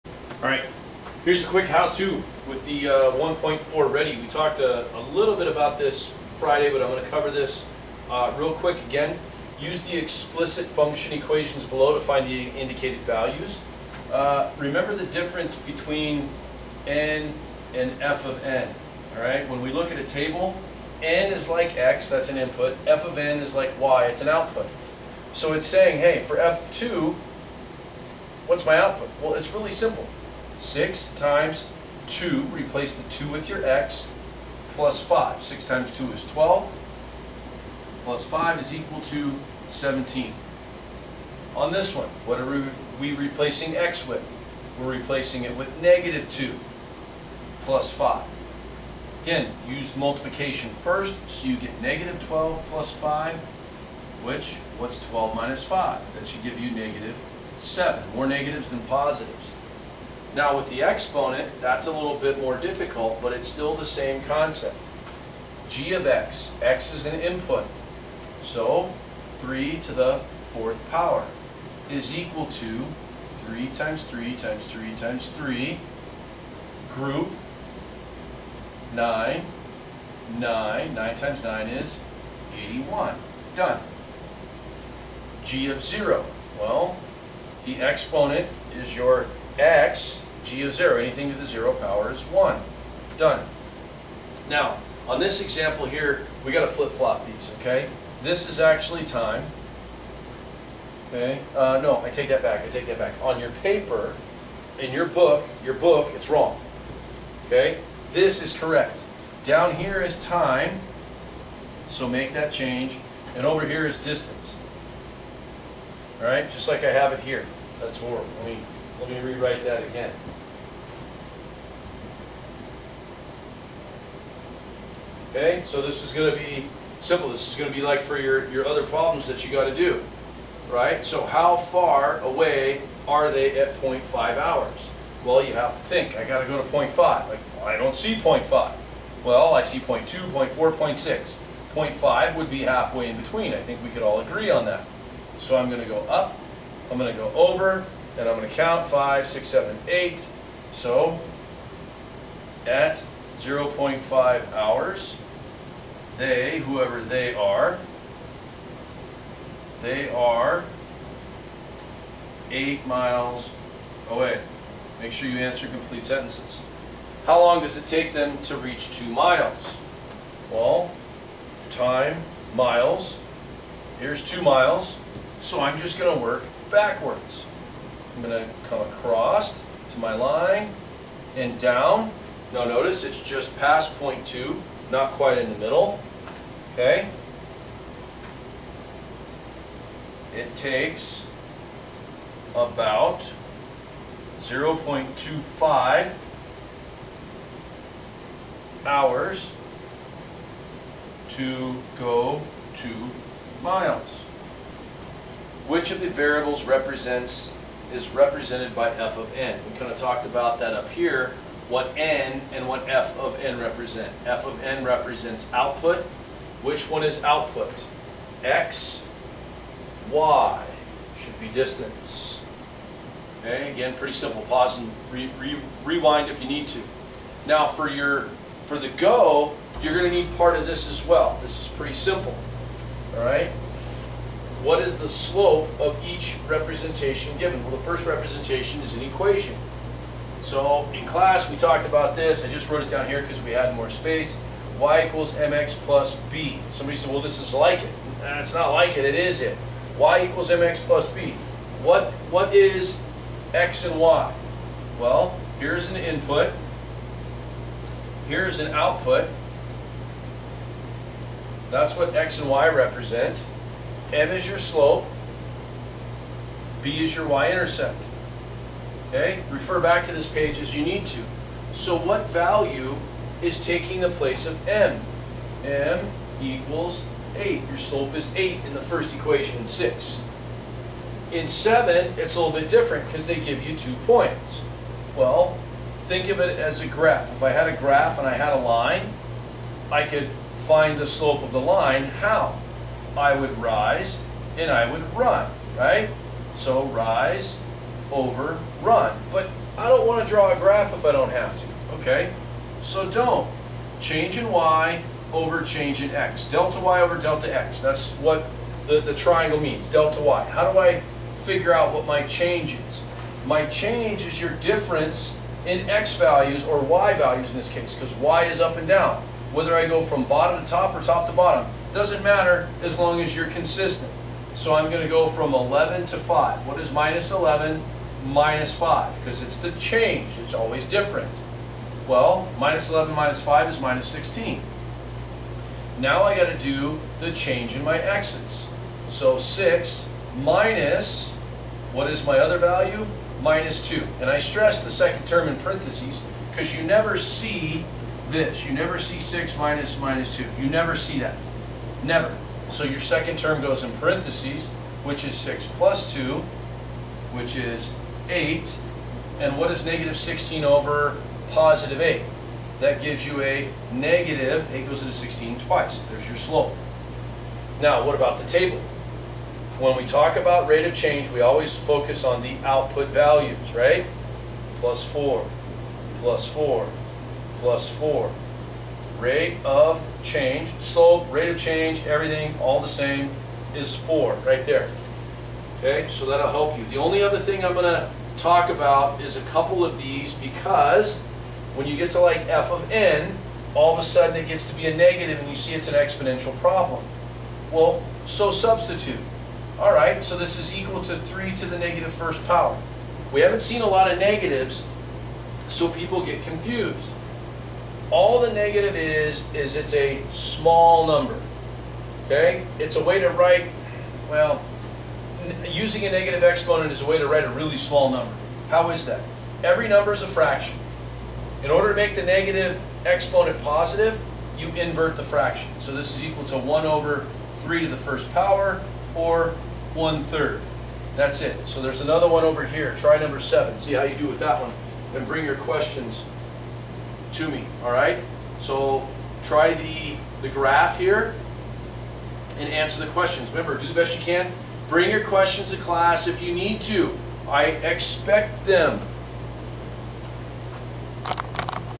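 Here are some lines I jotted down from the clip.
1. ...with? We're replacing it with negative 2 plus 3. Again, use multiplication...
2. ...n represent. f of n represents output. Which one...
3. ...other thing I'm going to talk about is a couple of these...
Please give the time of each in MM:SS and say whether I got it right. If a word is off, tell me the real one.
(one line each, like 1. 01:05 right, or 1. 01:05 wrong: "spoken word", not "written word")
1. 00:44 wrong: "5", not "3"
2. 03:33 right
3. 06:27 right.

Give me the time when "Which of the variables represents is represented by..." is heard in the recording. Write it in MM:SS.
03:25.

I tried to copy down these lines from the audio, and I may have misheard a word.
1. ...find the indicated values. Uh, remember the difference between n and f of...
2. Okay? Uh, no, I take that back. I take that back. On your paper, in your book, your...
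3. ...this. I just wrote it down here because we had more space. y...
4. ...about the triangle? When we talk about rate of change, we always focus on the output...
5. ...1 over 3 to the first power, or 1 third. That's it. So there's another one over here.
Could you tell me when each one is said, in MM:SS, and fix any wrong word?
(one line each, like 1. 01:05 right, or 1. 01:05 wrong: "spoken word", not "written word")
1. 00:12 right
2. 01:41 right
3. 04:02 right
4. 06:08 wrong: "table", not "triangle"
5. 07:06 right.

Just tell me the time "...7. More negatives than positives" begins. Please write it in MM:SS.
00:57.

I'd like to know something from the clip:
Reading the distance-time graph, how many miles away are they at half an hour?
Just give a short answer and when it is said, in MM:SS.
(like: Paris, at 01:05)
8 miles, at 02:42.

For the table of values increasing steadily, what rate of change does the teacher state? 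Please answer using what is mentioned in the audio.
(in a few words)
4.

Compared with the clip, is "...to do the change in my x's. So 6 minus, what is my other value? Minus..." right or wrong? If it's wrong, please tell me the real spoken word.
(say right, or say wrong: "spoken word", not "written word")
right.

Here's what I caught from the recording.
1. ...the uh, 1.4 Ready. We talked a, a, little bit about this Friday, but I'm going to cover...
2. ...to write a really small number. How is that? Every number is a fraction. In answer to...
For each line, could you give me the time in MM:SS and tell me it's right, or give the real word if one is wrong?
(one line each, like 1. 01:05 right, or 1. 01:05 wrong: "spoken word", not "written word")
1. 00:02 right
2. 06:57 wrong: "order", not "answer".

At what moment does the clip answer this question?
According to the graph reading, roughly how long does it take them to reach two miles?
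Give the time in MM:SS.
03:14.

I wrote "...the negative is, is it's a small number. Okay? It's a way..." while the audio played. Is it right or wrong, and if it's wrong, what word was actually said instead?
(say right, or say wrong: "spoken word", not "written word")
right.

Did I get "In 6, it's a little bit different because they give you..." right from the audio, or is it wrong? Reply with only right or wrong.
wrong.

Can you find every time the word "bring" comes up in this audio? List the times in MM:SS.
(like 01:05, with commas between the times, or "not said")
07:15, 07:24.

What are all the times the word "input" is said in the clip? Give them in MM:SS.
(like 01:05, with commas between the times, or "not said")
00:22, 01:07, 04:15.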